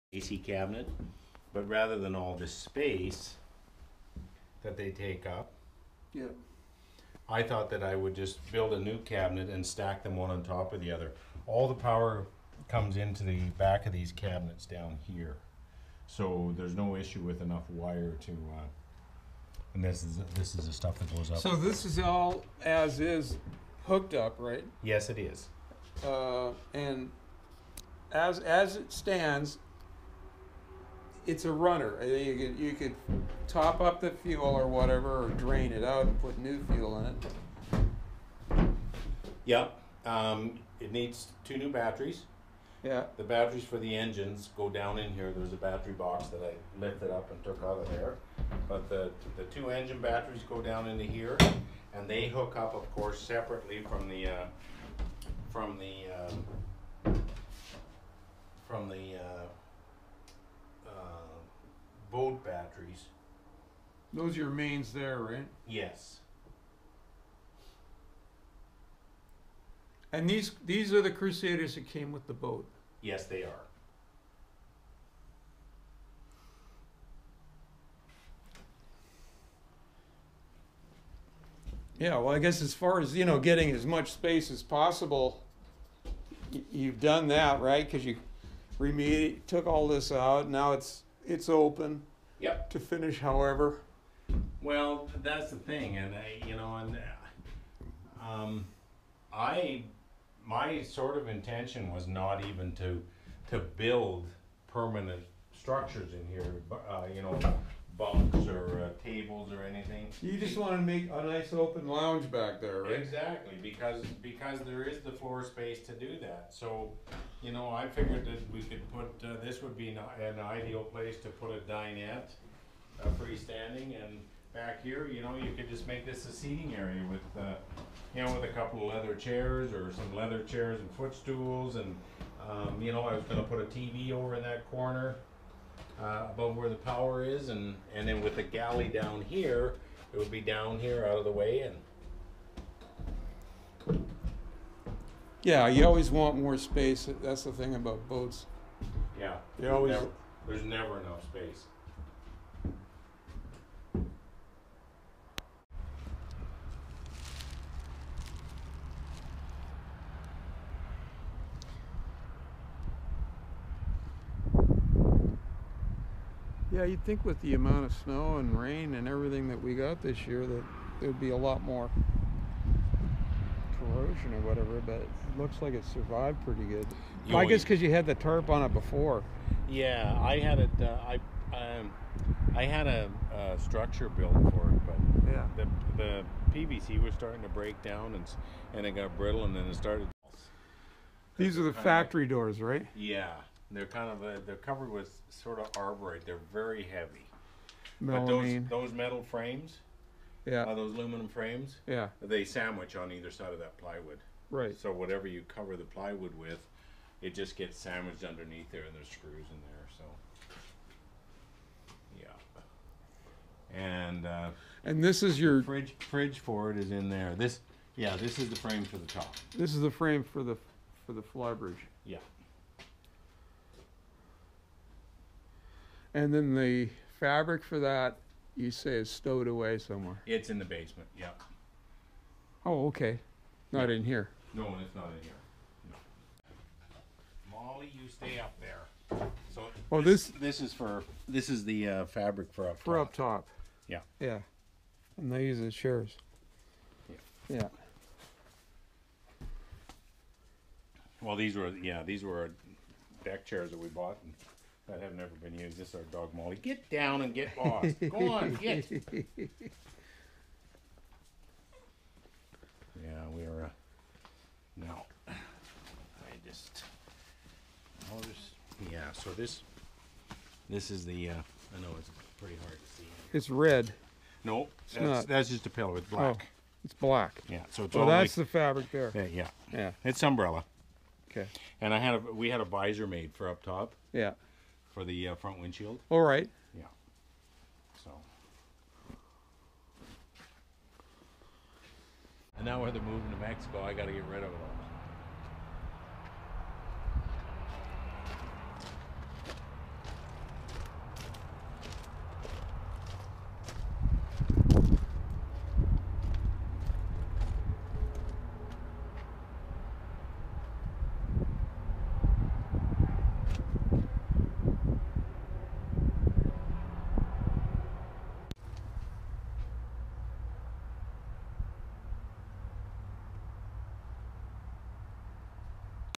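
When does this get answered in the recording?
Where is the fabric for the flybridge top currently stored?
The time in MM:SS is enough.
03:50.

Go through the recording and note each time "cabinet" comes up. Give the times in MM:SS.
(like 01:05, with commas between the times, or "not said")
00:00, 00:08, 00:14.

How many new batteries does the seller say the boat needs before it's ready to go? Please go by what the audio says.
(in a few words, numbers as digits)
2.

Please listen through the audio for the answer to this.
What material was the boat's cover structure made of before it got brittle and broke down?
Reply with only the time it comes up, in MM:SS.
03:06.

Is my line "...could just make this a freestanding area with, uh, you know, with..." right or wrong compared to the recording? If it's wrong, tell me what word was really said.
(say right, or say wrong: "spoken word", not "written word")
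wrong: "seating", not "freestanding".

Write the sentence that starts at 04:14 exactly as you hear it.
And that have never been used.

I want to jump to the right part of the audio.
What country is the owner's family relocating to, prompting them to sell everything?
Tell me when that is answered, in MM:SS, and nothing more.
04:53.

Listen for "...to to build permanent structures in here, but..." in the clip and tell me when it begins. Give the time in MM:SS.
01:42.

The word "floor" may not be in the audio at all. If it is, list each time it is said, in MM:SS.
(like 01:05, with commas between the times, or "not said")
01:55.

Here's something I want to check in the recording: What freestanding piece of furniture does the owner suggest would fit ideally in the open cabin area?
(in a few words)
A dinette.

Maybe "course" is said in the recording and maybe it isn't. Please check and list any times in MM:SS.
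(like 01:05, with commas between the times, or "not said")
00:52.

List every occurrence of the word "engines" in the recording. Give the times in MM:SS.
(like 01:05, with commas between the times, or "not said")
00:43, 00:49.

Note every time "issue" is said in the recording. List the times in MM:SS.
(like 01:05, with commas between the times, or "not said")
00:16.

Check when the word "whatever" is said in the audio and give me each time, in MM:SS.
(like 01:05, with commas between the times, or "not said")
00:34, 02:54, 03:24.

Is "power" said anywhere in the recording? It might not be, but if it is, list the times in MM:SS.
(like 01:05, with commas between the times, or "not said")
00:11, 02:16.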